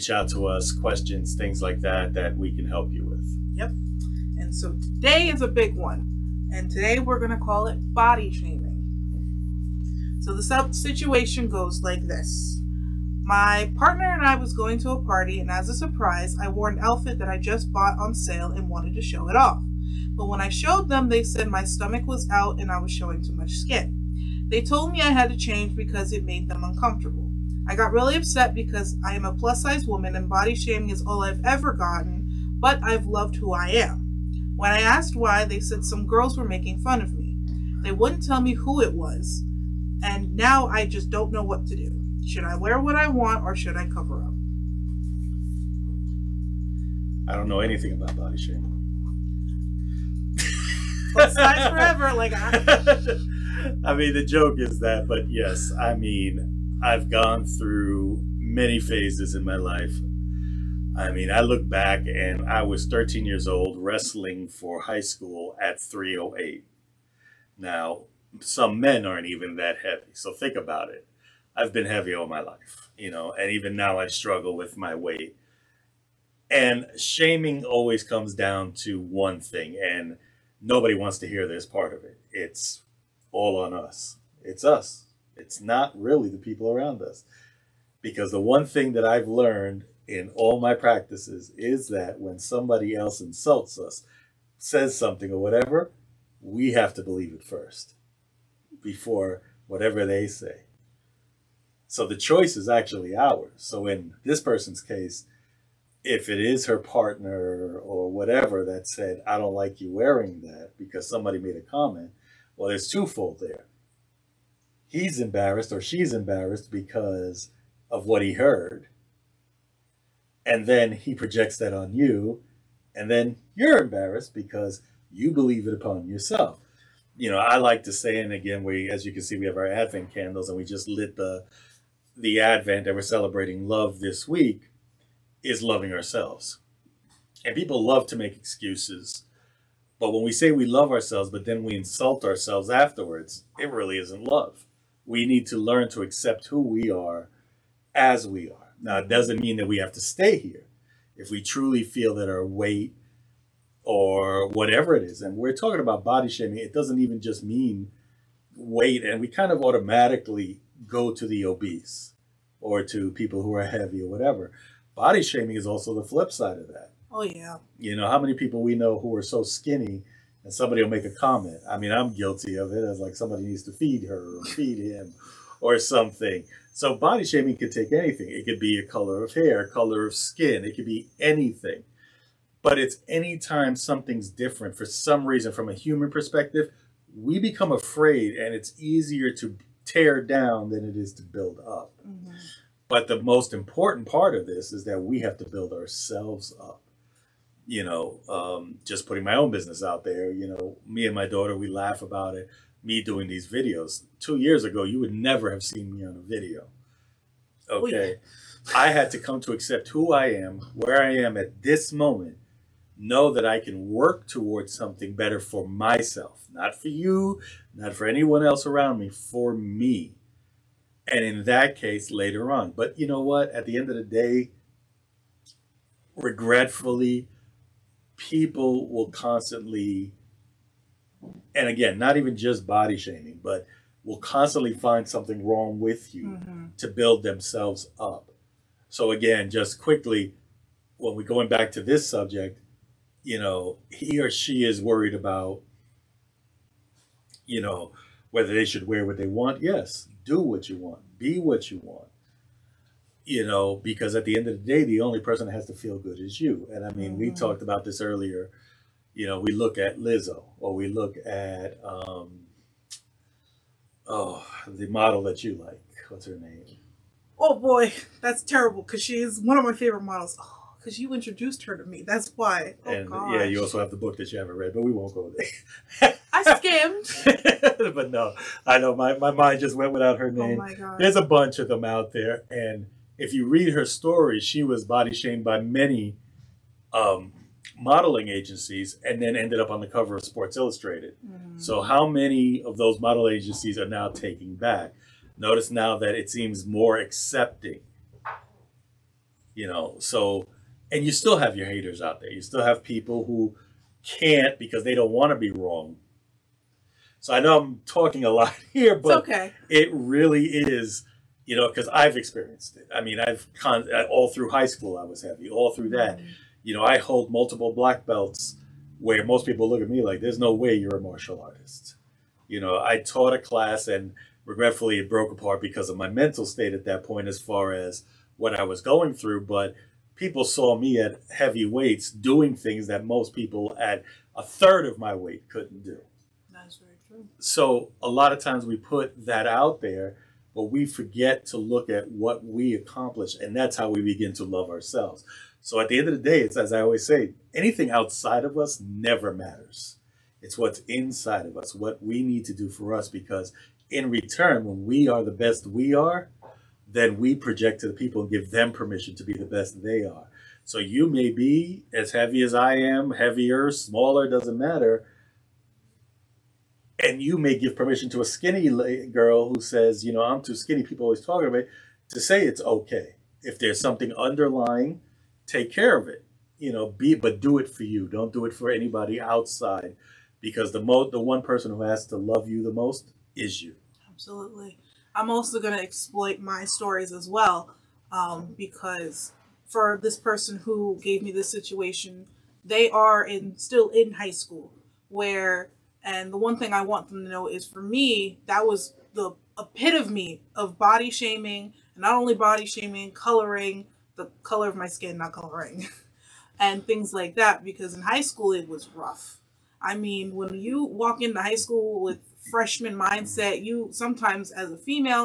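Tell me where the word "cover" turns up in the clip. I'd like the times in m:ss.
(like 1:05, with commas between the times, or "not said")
0:43, 4:49.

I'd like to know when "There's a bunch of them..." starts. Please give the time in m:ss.
4:40.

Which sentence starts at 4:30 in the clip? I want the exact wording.
Oh because you introduced her to me.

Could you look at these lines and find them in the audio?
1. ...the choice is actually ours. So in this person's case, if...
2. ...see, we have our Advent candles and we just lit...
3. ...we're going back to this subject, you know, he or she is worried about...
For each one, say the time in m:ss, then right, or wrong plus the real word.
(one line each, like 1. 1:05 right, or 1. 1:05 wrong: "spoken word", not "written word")
1. 1:42 right
2. 2:09 right
3. 4:01 right.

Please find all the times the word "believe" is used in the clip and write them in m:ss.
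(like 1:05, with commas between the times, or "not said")
1:37, 2:05.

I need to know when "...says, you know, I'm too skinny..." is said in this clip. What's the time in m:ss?
6:09.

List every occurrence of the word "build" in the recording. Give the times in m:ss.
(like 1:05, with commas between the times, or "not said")
3:11, 3:15, 3:56.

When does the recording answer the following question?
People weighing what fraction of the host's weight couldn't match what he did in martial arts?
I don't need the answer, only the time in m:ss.
5:34.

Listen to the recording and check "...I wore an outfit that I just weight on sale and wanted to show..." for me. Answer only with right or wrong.
wrong.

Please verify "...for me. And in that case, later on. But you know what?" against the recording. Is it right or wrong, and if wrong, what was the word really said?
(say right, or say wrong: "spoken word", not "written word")
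right.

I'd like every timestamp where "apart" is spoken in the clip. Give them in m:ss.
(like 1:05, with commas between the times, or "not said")
5:25.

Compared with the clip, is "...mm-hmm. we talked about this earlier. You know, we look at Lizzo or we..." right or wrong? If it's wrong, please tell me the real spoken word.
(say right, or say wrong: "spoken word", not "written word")
right.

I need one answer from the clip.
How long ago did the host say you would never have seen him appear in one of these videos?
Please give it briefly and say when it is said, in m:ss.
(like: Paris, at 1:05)
2 years ago, at 3:24.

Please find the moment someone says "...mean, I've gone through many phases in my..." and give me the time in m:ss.
0:55.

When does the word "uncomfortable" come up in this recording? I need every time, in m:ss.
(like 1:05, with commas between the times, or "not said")
0:26.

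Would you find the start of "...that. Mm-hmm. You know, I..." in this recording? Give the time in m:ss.
5:15.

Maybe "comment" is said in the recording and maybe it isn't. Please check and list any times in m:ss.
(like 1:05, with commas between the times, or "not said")
1:51, 2:51.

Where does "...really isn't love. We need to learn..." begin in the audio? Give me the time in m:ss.
2:23.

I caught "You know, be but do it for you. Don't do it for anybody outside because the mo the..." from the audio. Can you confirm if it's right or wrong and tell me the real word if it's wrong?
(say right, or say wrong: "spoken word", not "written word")
right.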